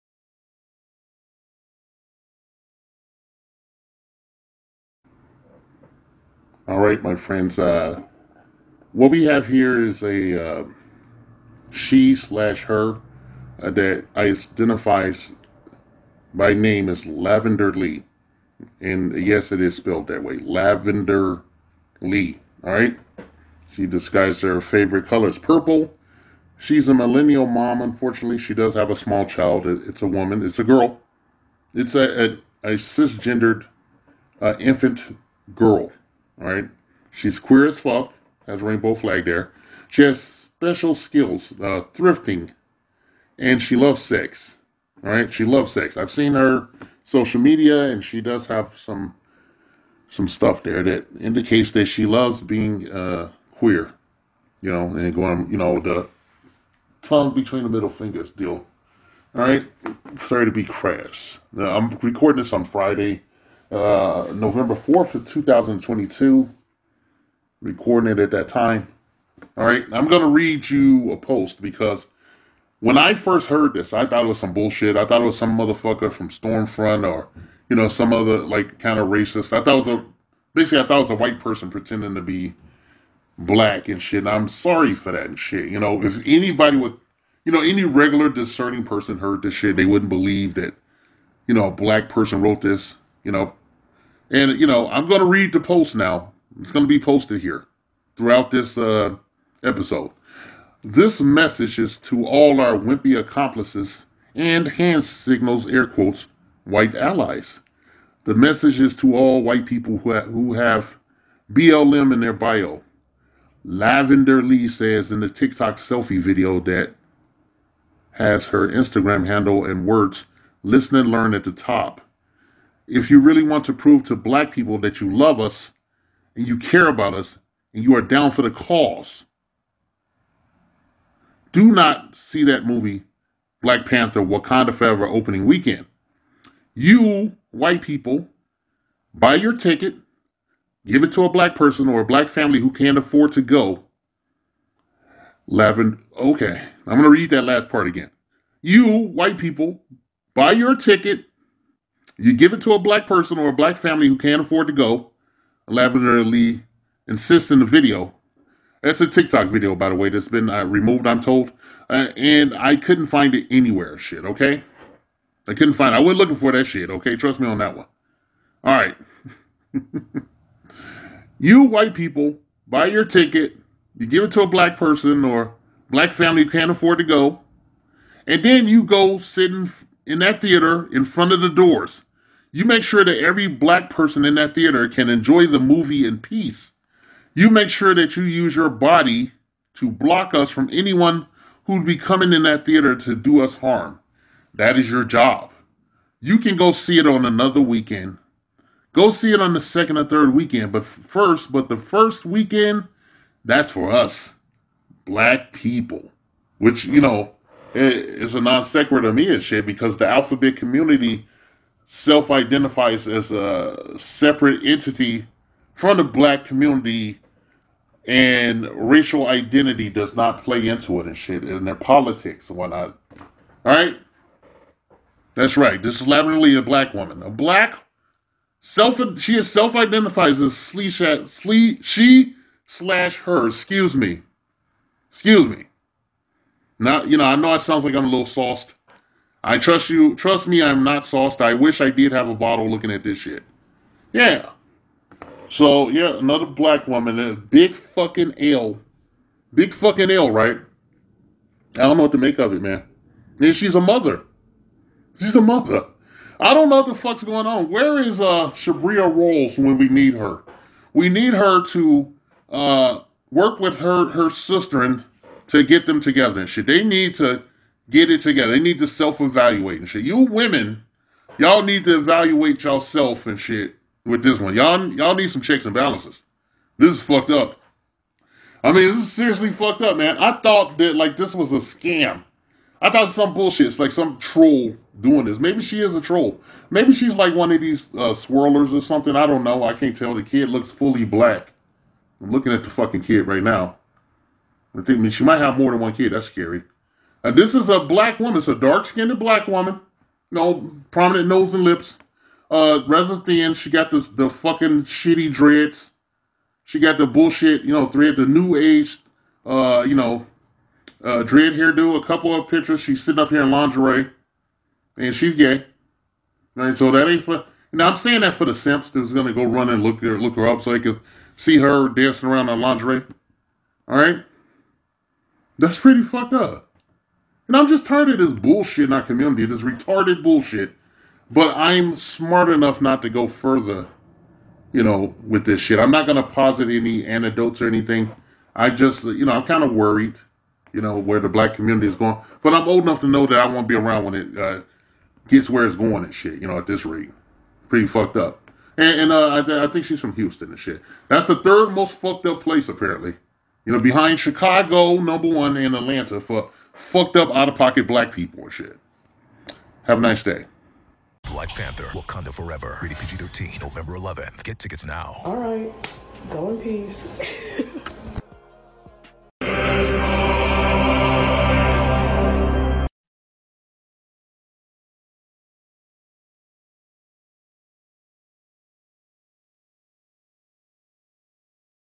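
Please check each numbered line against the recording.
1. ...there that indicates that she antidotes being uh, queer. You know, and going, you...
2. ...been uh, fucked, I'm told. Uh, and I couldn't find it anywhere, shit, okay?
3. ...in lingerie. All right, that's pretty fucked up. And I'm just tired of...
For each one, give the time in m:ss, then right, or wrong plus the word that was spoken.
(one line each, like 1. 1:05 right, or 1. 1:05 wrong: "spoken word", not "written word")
1. 0:50 wrong: "loves", not "antidotes"
2. 2:40 wrong: "removed", not "fucked"
3. 5:22 right.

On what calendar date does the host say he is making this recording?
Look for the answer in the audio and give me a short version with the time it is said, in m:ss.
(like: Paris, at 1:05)
November 4, 2022, at 1:04.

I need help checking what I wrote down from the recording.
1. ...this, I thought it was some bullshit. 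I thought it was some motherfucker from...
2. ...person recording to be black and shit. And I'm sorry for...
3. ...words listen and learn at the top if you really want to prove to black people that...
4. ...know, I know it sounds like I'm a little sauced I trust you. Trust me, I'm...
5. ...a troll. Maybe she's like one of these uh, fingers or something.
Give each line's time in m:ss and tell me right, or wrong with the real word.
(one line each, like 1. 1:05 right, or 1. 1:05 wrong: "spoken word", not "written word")
1. 1:13 right
2. 1:21 wrong: "pretending", not "recording"
3. 1:59 right
4. 3:57 right
5. 4:45 wrong: "swirlers", not "fingers".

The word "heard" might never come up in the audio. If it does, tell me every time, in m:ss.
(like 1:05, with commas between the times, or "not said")
1:13, 1:29.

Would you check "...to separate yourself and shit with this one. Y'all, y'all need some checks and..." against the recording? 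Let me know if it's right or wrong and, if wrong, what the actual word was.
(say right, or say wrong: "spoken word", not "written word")
wrong: "evaluate", not "separate".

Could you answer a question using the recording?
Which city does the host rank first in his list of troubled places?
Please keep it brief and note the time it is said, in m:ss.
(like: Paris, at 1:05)
Chicago, at 5:54.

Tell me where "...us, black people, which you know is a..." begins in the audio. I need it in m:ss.
3:23.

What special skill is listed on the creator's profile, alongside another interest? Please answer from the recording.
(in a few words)
Thrifting.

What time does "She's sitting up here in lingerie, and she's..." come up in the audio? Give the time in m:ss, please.
5:12.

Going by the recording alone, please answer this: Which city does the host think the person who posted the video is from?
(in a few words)
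Houston.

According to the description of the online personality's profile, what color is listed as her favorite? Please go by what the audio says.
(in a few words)
Purple.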